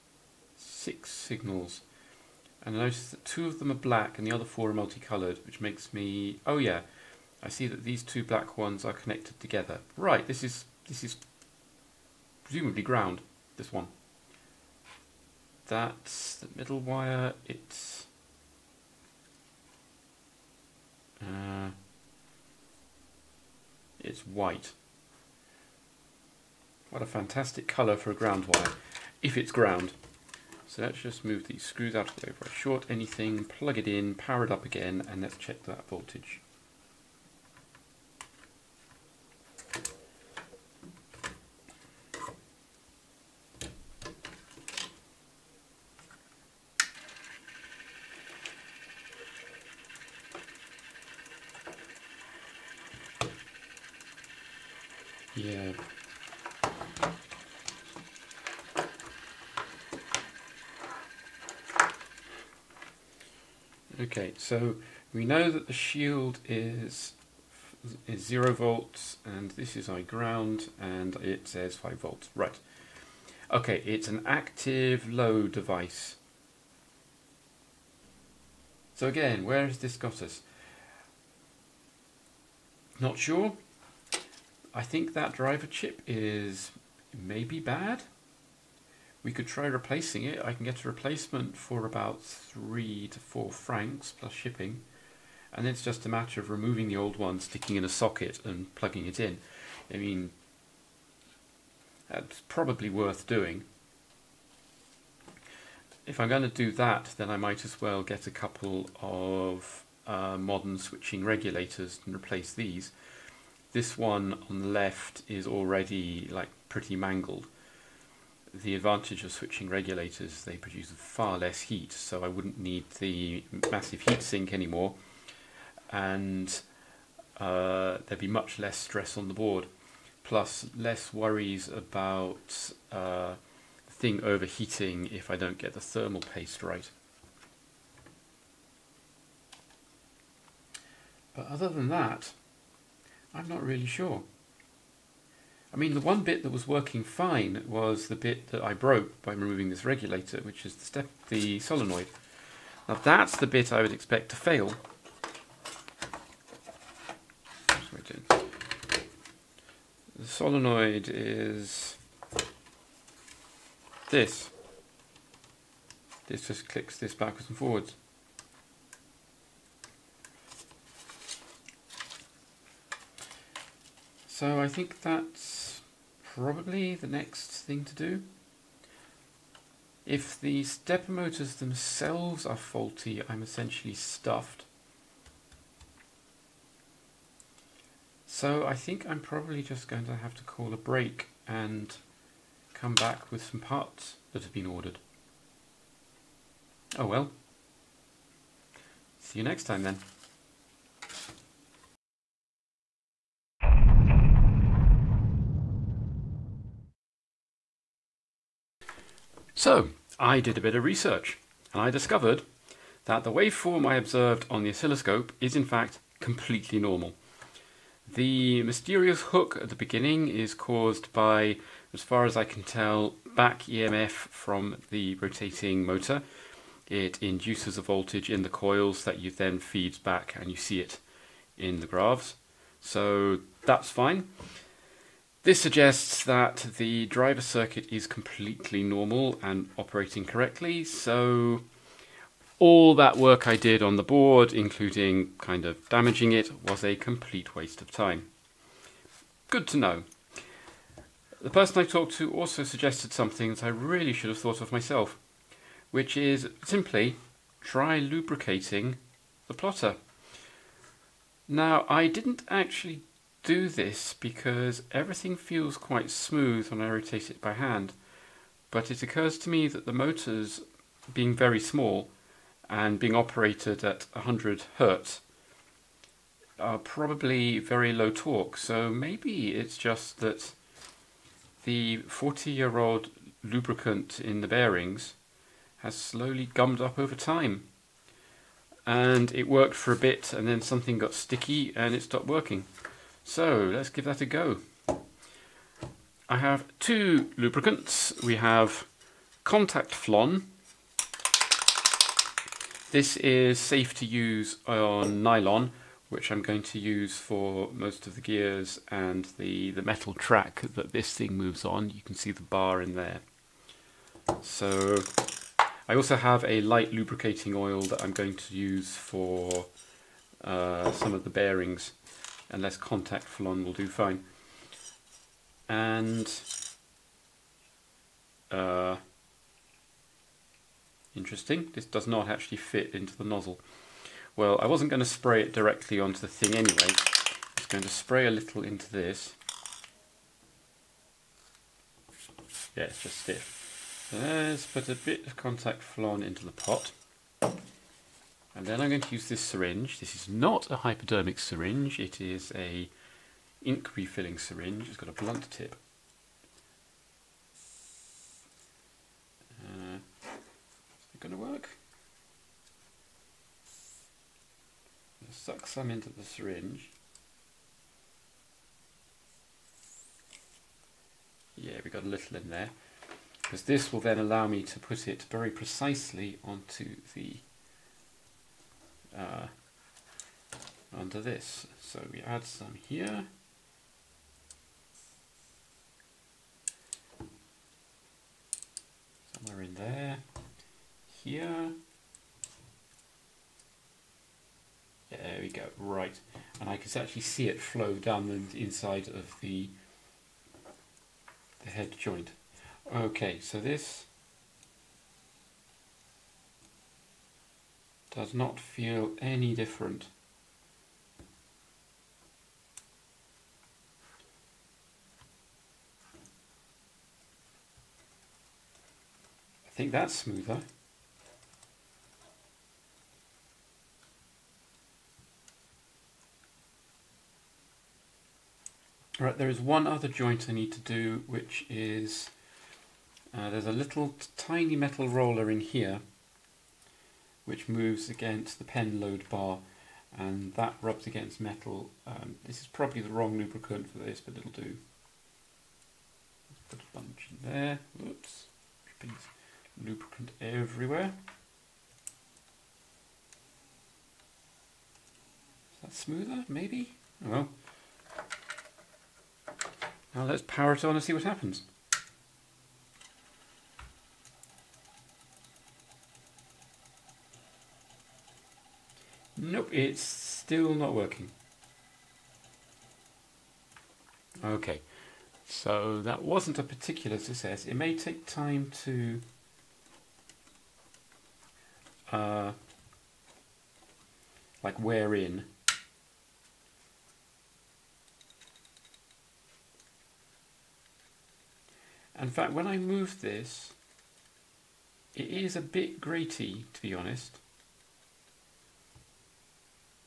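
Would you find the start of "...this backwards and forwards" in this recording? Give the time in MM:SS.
02:46.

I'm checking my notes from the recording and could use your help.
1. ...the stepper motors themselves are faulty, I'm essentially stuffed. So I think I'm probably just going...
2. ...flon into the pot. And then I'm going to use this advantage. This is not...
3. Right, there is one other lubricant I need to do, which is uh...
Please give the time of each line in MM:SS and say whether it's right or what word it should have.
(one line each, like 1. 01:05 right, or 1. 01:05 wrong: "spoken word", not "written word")
1. 03:00 right
2. 05:45 wrong: "syringe", not "advantage"
3. 07:09 wrong: "joint", not "lubricant".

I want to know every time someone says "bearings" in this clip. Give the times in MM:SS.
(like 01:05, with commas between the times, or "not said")
04:44, 05:21.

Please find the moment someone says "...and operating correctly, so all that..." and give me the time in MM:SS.
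03:59.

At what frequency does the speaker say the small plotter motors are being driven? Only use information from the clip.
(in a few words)
100 hertz.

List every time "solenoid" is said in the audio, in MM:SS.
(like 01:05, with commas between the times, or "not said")
02:31, 02:40.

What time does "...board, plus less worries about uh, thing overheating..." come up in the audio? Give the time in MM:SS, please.
02:09.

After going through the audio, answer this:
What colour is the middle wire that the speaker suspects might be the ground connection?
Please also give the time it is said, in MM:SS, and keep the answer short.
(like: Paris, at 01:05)
White, at 00:24.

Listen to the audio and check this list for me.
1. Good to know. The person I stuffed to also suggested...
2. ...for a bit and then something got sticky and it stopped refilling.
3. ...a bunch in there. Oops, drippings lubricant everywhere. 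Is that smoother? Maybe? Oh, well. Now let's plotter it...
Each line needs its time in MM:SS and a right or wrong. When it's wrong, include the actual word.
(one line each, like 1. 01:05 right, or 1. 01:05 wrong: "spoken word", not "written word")
1. 04:09 wrong: "talked", not "stuffed"
2. 04:49 wrong: "working", not "refilling"
3. 07:26 wrong: "power", not "plotter".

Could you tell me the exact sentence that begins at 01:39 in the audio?
I mean, that's probably worth doing.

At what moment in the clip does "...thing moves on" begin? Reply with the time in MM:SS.
05:11.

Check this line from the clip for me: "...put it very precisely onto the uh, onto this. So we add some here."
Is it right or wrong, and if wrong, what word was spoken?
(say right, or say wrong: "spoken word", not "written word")
right.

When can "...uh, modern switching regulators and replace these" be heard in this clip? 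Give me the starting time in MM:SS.
01:50.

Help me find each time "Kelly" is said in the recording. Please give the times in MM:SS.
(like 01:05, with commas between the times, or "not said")
not said.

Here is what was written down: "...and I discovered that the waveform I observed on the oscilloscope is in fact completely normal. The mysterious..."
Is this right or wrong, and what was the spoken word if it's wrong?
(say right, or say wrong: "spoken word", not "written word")
right.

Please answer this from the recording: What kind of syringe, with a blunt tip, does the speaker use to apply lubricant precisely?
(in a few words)
Ink refilling syringe.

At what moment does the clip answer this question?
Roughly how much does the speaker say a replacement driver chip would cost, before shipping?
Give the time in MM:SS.
01:32.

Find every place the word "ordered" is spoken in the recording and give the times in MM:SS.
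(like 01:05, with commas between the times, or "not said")
03:14.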